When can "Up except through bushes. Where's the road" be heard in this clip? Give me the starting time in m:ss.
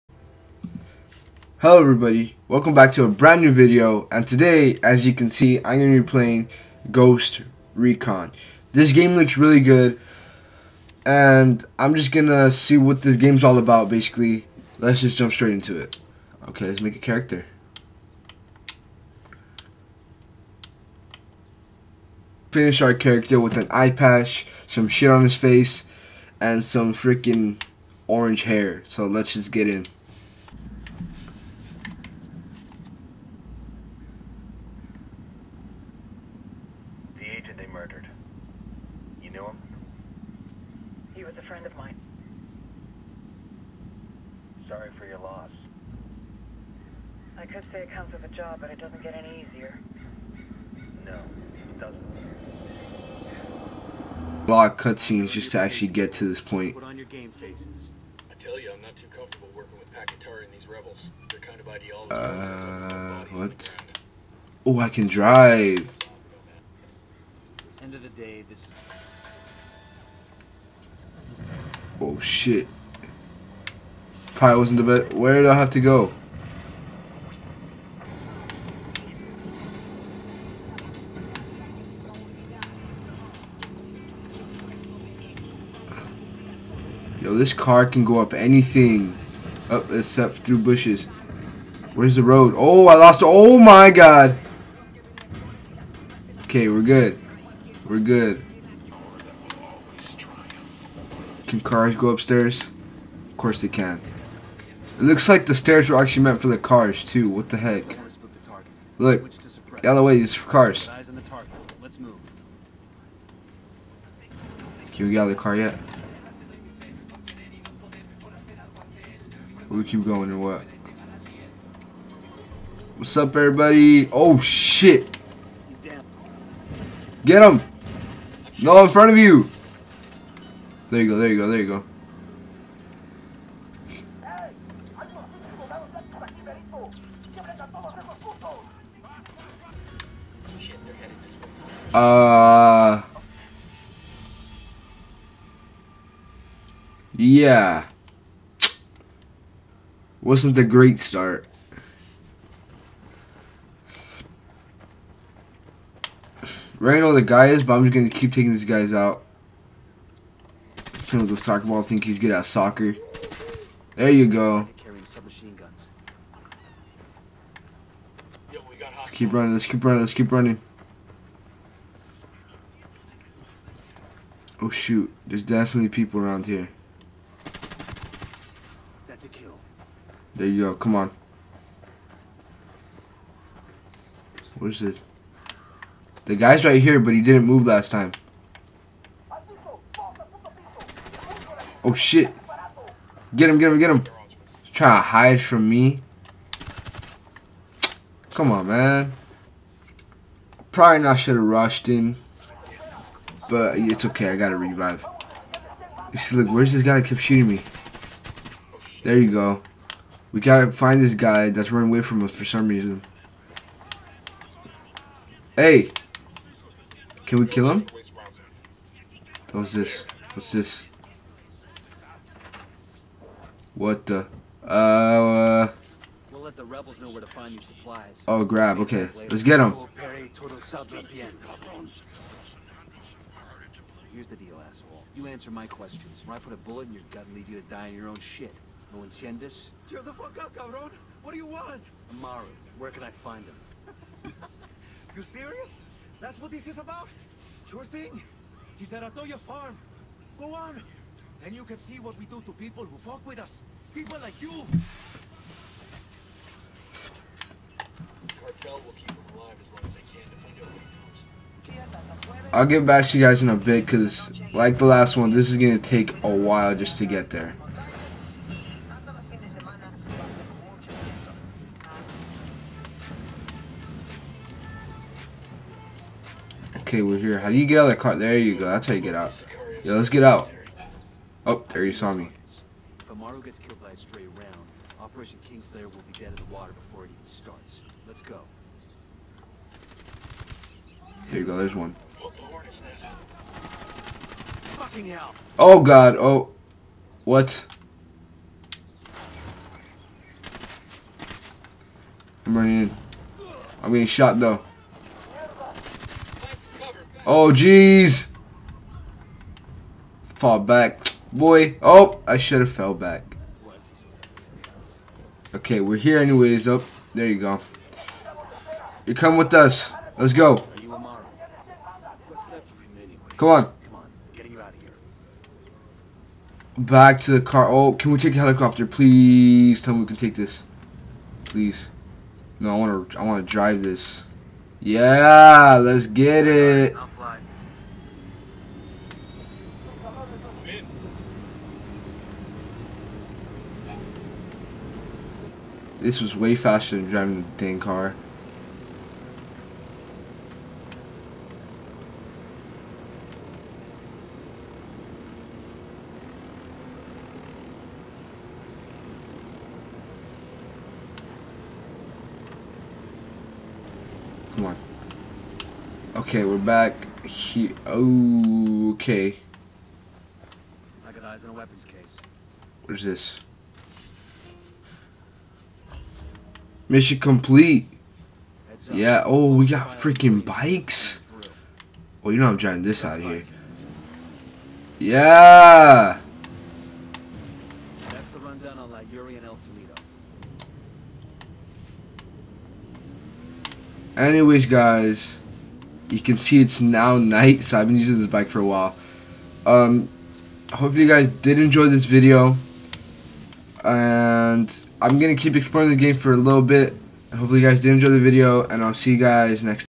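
1:29.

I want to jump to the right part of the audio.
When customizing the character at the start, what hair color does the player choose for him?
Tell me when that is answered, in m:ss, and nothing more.
0:28.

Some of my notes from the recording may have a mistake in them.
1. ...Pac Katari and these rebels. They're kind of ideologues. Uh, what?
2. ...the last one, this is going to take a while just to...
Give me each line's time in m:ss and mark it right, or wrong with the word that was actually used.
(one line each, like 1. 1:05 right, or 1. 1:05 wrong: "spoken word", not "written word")
1. 0:59 right
2. 4:24 right.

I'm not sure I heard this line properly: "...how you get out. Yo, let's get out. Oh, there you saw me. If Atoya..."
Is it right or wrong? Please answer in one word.
wrong.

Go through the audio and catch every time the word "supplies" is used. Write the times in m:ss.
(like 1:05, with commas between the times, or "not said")
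3:47.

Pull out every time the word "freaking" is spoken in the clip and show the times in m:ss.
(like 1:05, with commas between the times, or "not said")
0:26, 6:19.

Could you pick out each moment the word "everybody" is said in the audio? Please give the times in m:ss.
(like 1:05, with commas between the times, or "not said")
0:01, 2:03.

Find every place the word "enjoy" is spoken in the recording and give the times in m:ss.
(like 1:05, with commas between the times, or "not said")
6:41, 6:47.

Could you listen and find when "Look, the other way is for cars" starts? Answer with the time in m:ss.
1:48.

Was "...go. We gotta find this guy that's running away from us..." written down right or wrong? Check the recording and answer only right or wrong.
right.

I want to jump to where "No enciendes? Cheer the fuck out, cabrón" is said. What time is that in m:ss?
3:58.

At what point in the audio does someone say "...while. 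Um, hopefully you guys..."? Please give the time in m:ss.
6:38.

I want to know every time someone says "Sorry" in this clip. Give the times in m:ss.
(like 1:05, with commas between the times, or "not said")
0:44.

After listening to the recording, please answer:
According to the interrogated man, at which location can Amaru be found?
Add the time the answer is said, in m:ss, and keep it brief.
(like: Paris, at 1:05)
Atoya Farm, at 4:09.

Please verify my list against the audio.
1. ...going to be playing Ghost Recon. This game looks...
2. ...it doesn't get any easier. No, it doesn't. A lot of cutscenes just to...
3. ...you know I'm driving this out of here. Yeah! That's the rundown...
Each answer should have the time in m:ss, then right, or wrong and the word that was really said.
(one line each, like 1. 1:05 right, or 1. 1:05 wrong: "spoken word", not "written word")
1. 0:05 right
2. 0:48 right
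3. 6:22 right.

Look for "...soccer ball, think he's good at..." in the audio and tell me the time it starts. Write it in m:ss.
2:41.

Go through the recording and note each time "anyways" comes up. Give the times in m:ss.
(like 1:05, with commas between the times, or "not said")
5:16, 6:34.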